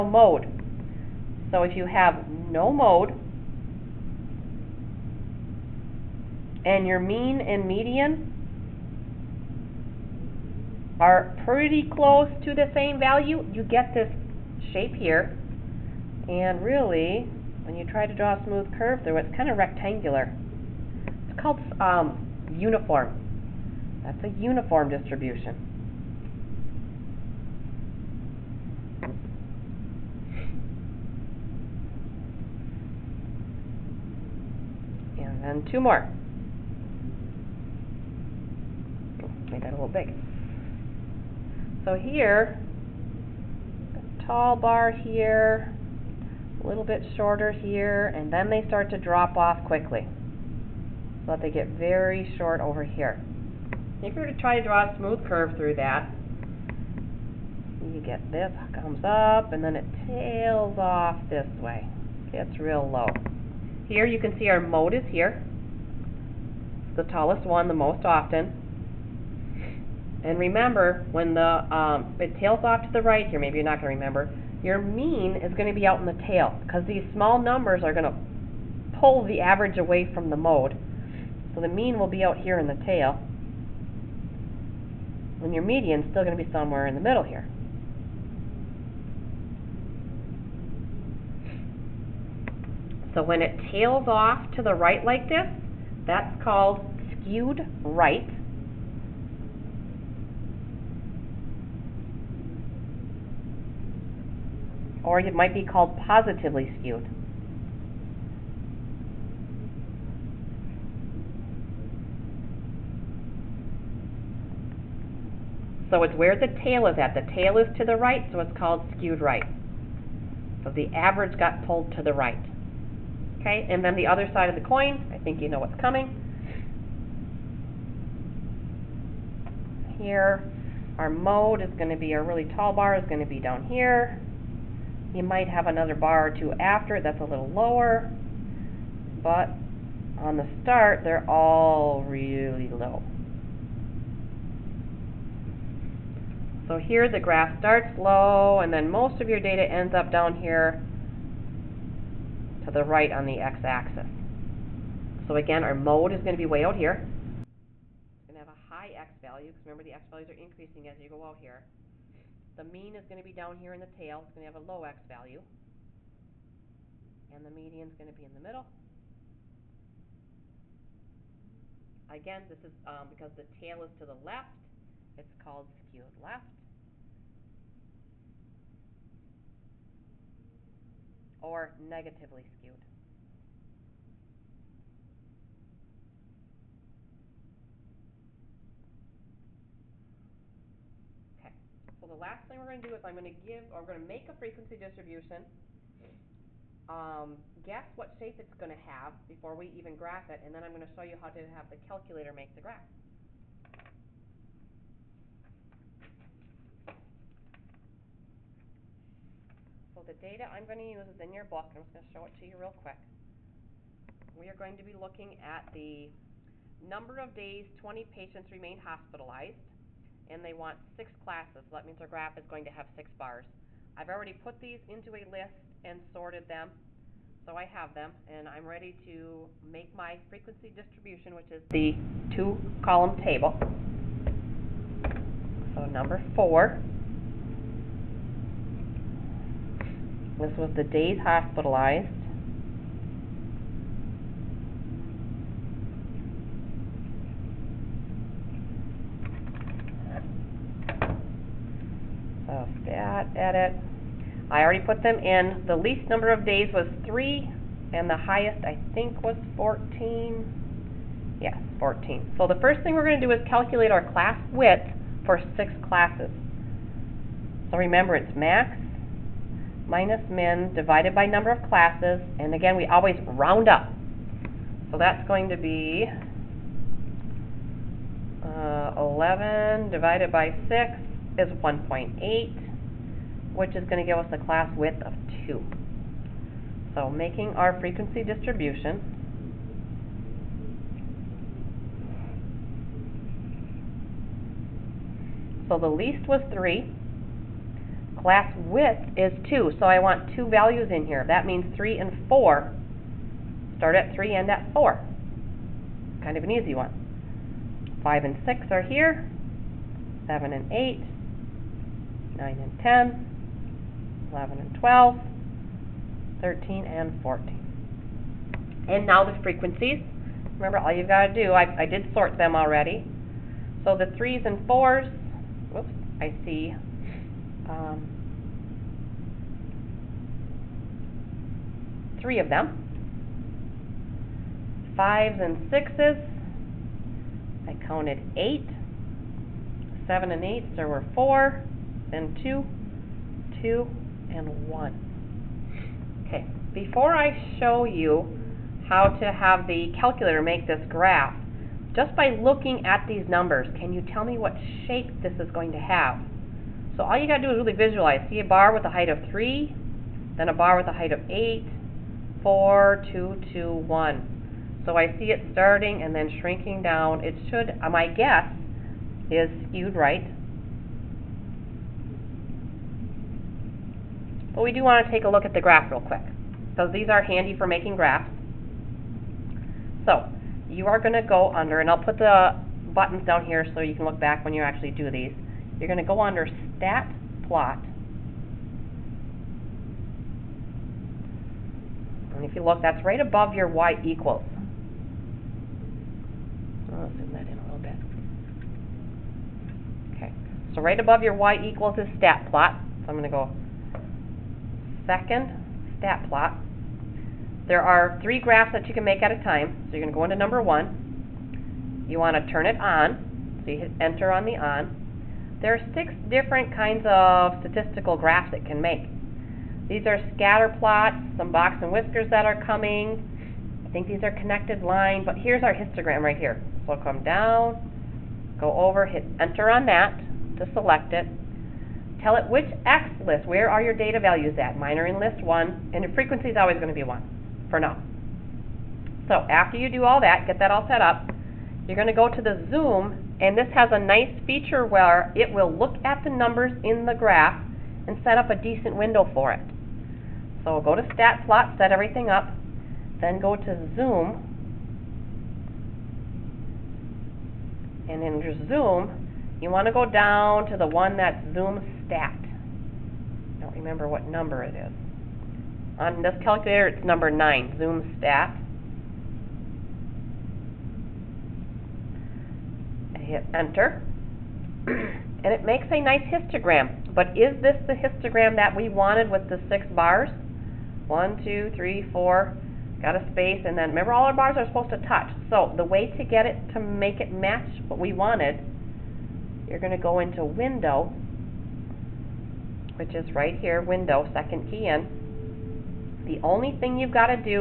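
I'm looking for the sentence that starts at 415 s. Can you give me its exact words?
There are six different kinds of statistical graphs it can make.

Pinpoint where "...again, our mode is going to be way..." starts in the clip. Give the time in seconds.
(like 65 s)
155 s.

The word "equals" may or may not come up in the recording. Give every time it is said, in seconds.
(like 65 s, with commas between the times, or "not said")
394 s, 401 s.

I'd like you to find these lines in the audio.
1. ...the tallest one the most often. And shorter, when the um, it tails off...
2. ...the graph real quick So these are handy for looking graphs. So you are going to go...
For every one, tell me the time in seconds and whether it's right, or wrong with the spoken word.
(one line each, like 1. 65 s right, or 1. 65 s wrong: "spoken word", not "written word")
1. 66 s wrong: "remember", not "shorter"
2. 375 s wrong: "making", not "looking".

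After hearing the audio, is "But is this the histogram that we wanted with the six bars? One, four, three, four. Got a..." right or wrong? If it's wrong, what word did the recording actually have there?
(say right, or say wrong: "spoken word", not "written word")
wrong: "two", not "four".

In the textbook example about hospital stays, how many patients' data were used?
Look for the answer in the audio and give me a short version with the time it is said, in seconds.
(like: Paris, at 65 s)
20, at 217 s.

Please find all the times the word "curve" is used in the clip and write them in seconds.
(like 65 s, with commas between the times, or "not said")
18 s, 55 s.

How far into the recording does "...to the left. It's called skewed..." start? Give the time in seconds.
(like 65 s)
173 s.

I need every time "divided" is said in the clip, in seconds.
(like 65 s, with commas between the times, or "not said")
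270 s, 279 s.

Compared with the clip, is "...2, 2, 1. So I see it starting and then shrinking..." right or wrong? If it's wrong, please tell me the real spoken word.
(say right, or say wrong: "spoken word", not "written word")
right.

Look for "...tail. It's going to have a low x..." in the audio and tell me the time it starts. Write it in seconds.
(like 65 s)
163 s.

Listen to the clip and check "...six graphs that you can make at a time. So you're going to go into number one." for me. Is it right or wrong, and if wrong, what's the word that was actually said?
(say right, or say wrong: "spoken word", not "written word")
wrong: "three", not "six".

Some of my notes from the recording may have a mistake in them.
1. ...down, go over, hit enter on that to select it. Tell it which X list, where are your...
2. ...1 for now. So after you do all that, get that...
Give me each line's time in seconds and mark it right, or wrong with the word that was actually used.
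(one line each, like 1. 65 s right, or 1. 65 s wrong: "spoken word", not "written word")
1. 427 s right
2. 437 s right.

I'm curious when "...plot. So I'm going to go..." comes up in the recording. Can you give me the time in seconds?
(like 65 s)
402 s.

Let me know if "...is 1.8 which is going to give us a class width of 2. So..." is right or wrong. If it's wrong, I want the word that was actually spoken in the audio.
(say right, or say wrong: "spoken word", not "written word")
right.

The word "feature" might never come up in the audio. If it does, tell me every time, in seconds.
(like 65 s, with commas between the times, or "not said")
444 s.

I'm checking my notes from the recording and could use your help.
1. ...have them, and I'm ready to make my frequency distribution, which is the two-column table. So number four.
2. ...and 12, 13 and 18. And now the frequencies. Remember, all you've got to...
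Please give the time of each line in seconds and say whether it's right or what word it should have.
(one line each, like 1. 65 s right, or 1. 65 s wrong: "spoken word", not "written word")
1. 227 s right
2. 314 s wrong: "14", not "18".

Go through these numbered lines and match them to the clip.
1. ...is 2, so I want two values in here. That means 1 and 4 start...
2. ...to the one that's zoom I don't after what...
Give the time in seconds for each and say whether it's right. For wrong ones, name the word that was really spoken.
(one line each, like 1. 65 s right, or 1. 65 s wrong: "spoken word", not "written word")
1. 299 s wrong: "3", not "1"
2. 460 s wrong: "remember", not "after".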